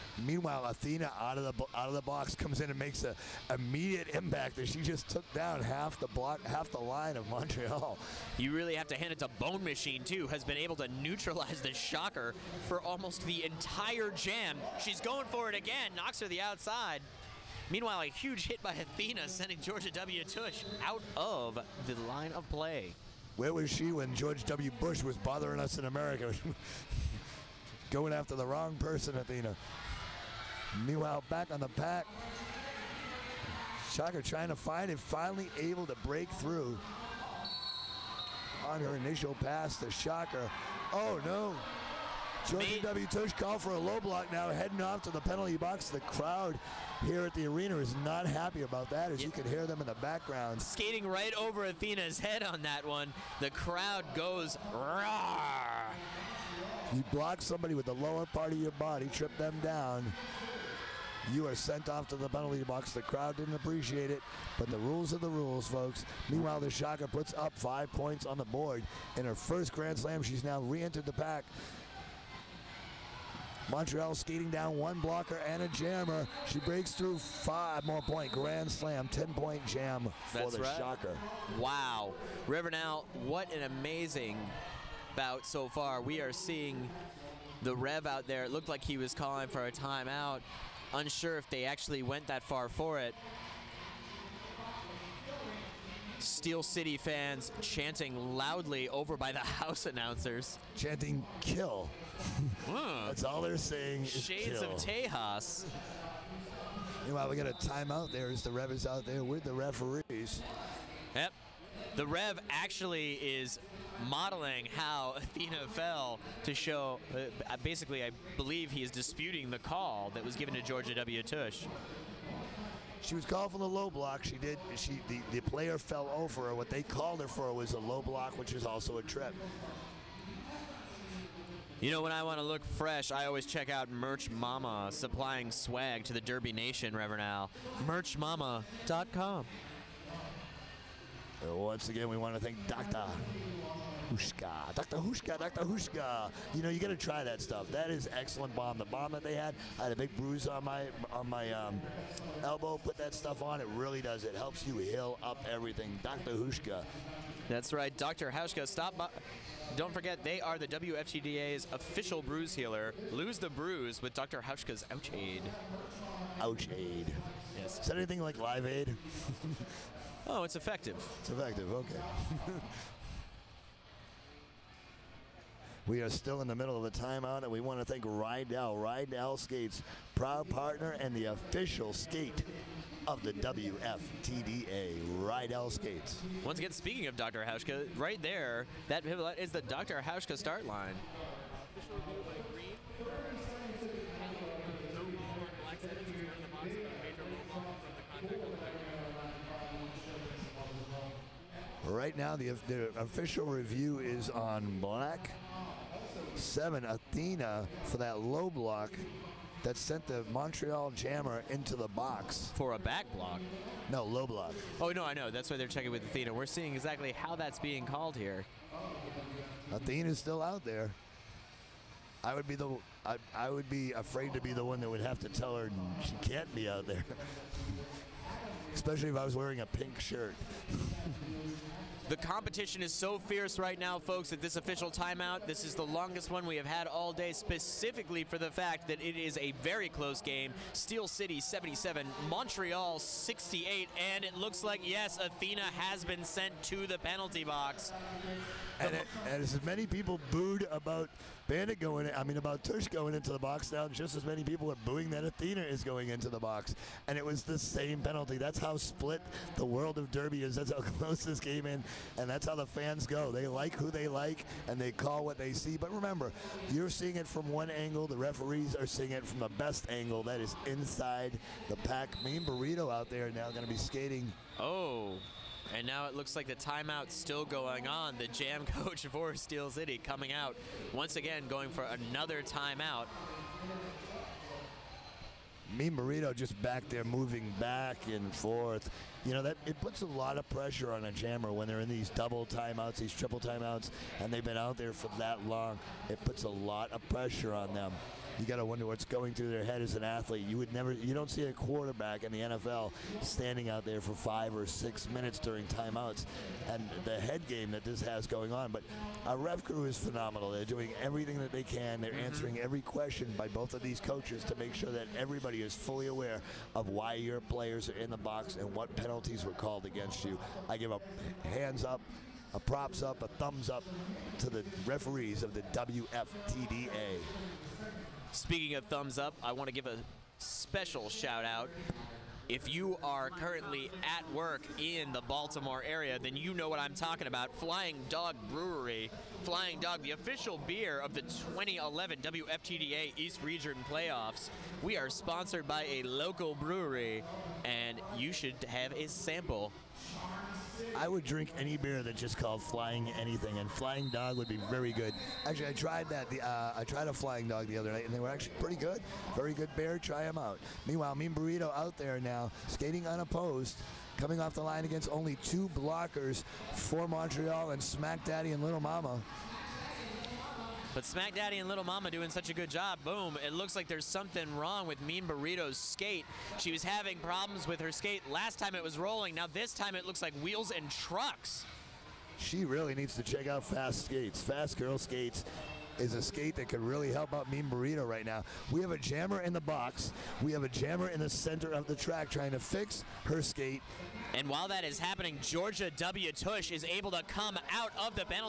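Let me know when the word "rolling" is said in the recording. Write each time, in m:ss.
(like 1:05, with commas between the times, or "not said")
6:18.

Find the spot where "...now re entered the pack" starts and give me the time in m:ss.
1:10.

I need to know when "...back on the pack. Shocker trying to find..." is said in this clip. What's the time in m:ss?
0:31.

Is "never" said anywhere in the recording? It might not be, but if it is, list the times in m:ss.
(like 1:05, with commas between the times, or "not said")
5:00.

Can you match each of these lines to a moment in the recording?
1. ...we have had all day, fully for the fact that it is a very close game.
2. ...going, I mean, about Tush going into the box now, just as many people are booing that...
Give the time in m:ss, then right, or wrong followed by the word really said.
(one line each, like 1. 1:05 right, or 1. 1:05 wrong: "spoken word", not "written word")
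1. 3:56 wrong: "specifically", not "fully"
2. 4:11 right.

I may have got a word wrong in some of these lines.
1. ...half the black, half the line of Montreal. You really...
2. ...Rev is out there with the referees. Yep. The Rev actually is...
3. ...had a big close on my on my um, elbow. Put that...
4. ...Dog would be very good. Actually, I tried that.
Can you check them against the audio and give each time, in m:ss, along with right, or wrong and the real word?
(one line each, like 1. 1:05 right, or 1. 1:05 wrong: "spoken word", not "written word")
1. 0:05 wrong: "block", not "black"
2. 1:48 right
3. 2:29 wrong: "bruise", not "close"
4. 5:54 right.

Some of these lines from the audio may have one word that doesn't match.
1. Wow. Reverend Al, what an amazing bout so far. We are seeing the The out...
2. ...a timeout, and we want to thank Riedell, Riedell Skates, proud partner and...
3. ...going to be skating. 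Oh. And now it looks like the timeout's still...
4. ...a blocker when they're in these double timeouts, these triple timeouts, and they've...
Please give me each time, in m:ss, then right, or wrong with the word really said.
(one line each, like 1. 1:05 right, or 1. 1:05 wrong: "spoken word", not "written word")
1. 1:21 wrong: "Rev", not "The"
2. 2:56 right
3. 4:33 right
4. 4:51 wrong: "jammer", not "blocker".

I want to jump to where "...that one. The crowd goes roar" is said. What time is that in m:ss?
0:52.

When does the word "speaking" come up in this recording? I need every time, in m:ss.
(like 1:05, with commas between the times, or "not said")
3:06, 5:28.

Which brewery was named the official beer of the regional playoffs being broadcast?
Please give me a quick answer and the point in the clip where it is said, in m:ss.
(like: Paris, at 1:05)
Flying Dog Brewery, at 5:37.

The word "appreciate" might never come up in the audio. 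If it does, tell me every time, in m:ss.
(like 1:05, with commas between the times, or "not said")
1:03.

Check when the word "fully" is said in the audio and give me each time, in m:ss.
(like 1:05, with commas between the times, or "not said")
5:15.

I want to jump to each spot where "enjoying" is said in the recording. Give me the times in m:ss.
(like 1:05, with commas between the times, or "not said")
not said.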